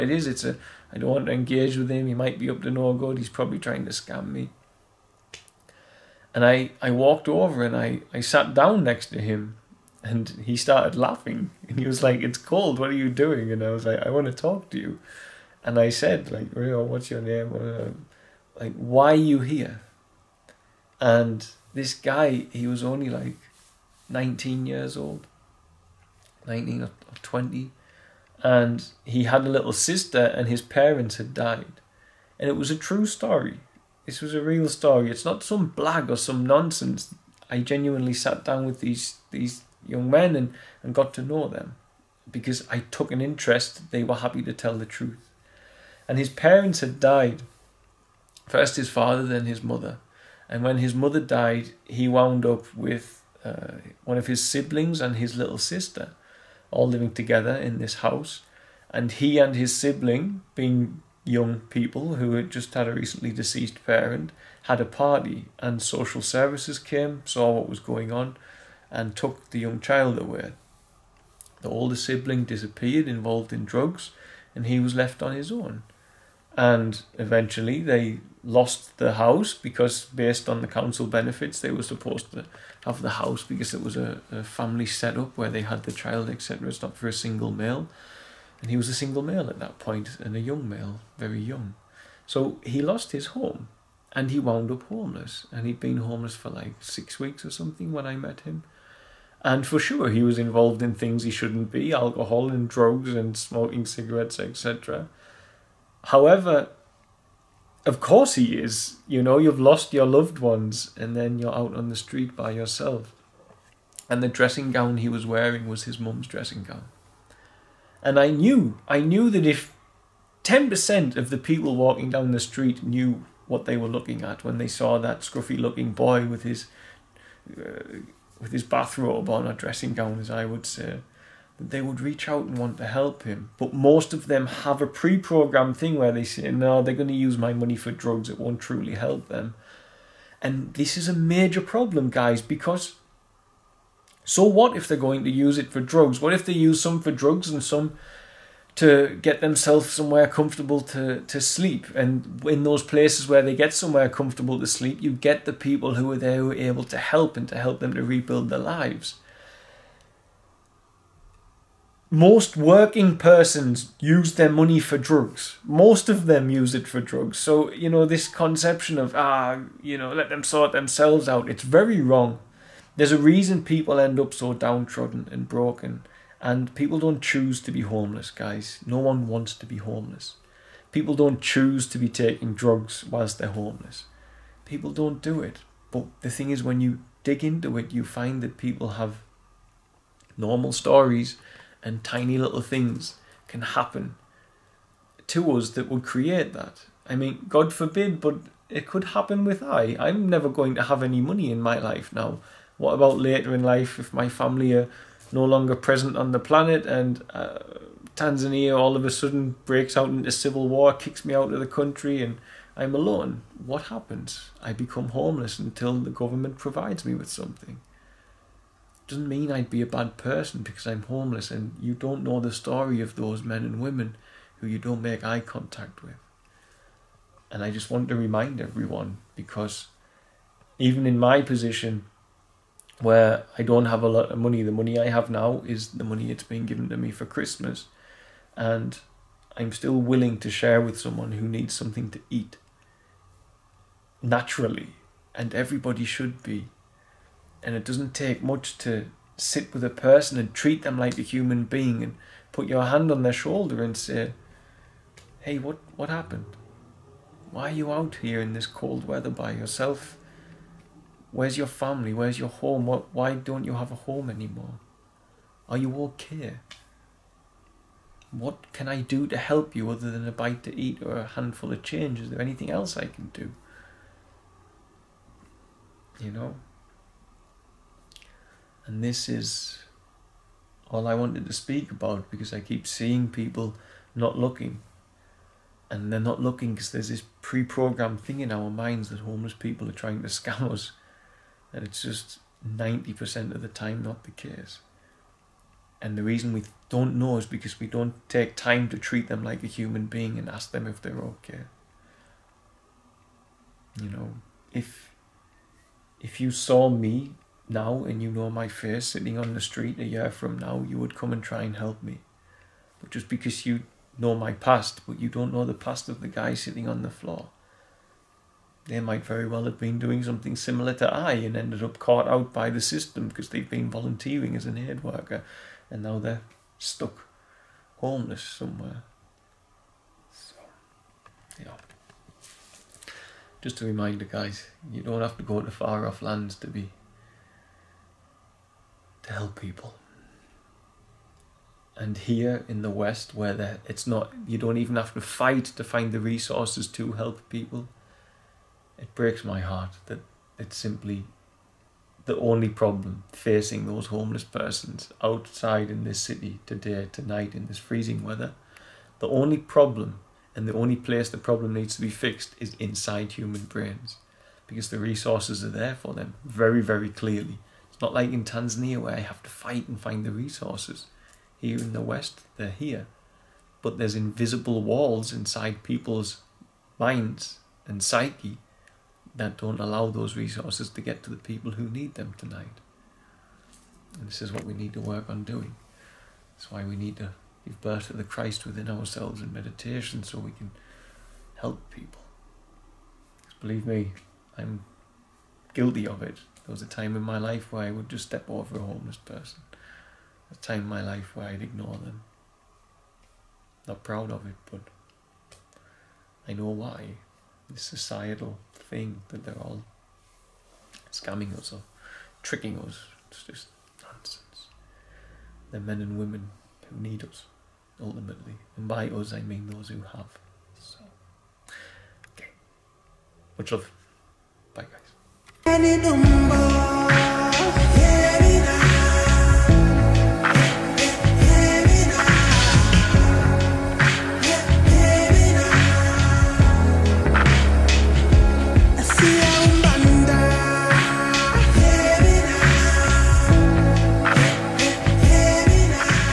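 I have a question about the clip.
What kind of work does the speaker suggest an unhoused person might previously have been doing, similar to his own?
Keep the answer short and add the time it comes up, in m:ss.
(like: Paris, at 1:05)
Aid worker, at 5:24.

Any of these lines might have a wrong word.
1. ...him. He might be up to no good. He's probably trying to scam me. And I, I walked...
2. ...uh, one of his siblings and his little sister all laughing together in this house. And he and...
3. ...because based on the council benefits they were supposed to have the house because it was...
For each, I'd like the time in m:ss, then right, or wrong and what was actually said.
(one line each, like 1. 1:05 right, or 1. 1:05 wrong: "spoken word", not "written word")
1. 0:01 right
2. 0:53 wrong: "living", not "laughing"
3. 1:19 right.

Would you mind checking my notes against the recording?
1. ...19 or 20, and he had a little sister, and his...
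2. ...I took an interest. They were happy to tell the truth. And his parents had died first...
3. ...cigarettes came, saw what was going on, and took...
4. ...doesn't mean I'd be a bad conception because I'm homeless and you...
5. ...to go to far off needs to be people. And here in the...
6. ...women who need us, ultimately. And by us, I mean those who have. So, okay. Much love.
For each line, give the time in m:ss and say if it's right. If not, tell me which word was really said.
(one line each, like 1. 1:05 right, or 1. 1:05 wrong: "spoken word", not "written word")
1. 0:26 right
2. 0:42 right
3. 1:06 wrong: "services", not "cigarettes"
4. 3:39 wrong: "person", not "conception"
5. 5:35 wrong: "lands", not "needs"
6. 6:56 right.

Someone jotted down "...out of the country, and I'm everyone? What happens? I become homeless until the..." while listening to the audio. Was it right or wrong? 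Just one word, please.
wrong.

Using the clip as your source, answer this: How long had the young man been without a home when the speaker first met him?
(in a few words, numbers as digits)
6 weeks.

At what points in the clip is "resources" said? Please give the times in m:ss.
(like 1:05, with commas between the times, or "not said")
5:46, 6:04, 6:10, 6:20.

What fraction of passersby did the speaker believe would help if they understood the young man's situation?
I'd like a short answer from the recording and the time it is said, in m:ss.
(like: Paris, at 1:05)
10%, at 2:00.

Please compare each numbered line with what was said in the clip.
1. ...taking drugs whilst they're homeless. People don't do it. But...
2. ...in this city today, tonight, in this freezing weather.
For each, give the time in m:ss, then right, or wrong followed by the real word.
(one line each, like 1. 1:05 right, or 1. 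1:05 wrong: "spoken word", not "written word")
1. 3:02 right
2. 5:55 right.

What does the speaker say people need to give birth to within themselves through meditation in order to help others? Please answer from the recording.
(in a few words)
The Christ.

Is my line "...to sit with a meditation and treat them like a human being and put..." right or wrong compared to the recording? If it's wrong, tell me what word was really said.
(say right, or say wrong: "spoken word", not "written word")
wrong: "person", not "meditation".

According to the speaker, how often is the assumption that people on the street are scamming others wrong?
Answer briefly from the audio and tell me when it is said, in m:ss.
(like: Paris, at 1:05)
90% of the time, at 4:52.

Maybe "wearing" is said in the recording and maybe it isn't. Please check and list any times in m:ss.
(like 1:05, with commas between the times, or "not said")
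1:55.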